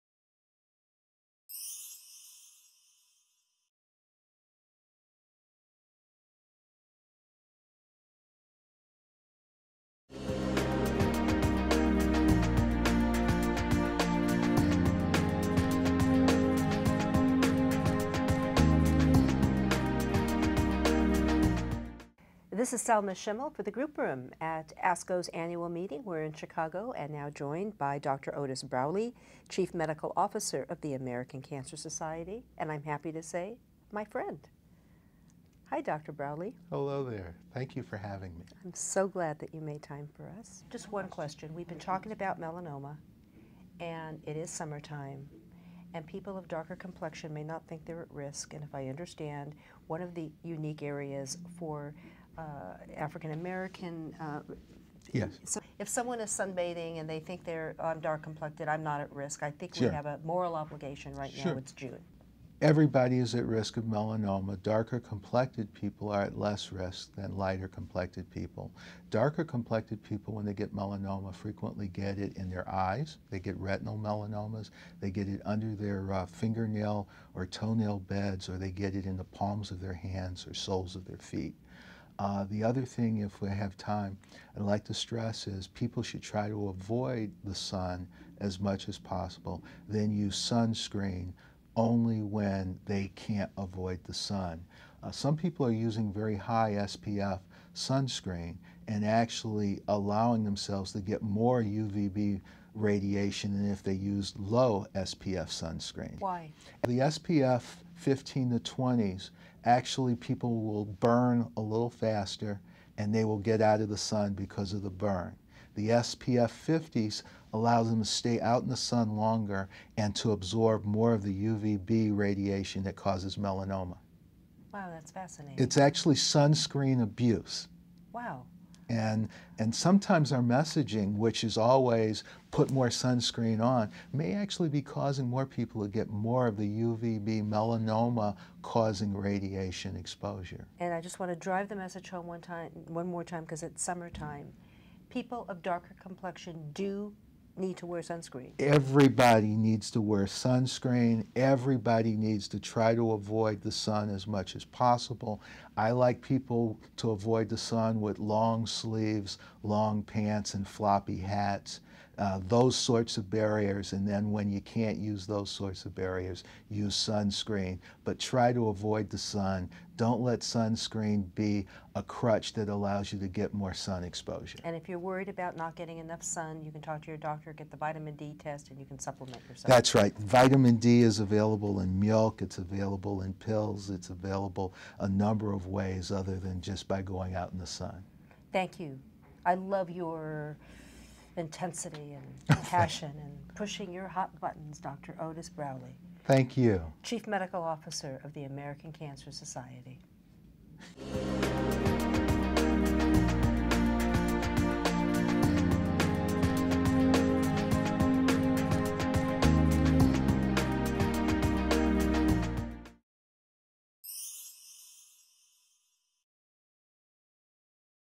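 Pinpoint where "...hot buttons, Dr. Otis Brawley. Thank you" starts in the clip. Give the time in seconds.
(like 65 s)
194 s.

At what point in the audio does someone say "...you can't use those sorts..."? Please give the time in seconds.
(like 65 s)
164 s.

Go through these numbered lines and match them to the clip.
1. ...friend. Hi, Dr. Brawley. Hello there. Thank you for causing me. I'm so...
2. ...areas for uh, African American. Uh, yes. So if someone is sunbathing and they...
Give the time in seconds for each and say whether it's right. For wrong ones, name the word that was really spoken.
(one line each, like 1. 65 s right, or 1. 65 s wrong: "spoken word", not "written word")
1. 34 s wrong: "having", not "causing"
2. 50 s right.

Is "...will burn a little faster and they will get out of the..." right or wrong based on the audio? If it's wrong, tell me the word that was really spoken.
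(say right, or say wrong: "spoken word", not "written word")
right.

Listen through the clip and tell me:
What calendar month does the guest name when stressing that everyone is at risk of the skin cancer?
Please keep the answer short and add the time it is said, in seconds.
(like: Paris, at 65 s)
June, at 61 s.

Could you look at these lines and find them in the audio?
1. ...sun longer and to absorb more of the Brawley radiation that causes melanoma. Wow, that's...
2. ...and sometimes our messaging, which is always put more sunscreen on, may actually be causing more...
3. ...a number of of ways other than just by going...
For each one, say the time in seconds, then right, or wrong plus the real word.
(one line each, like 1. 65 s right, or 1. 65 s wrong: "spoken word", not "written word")
1. 118 s wrong: "UVB", not "Brawley"
2. 129 s right
3. 184 s right.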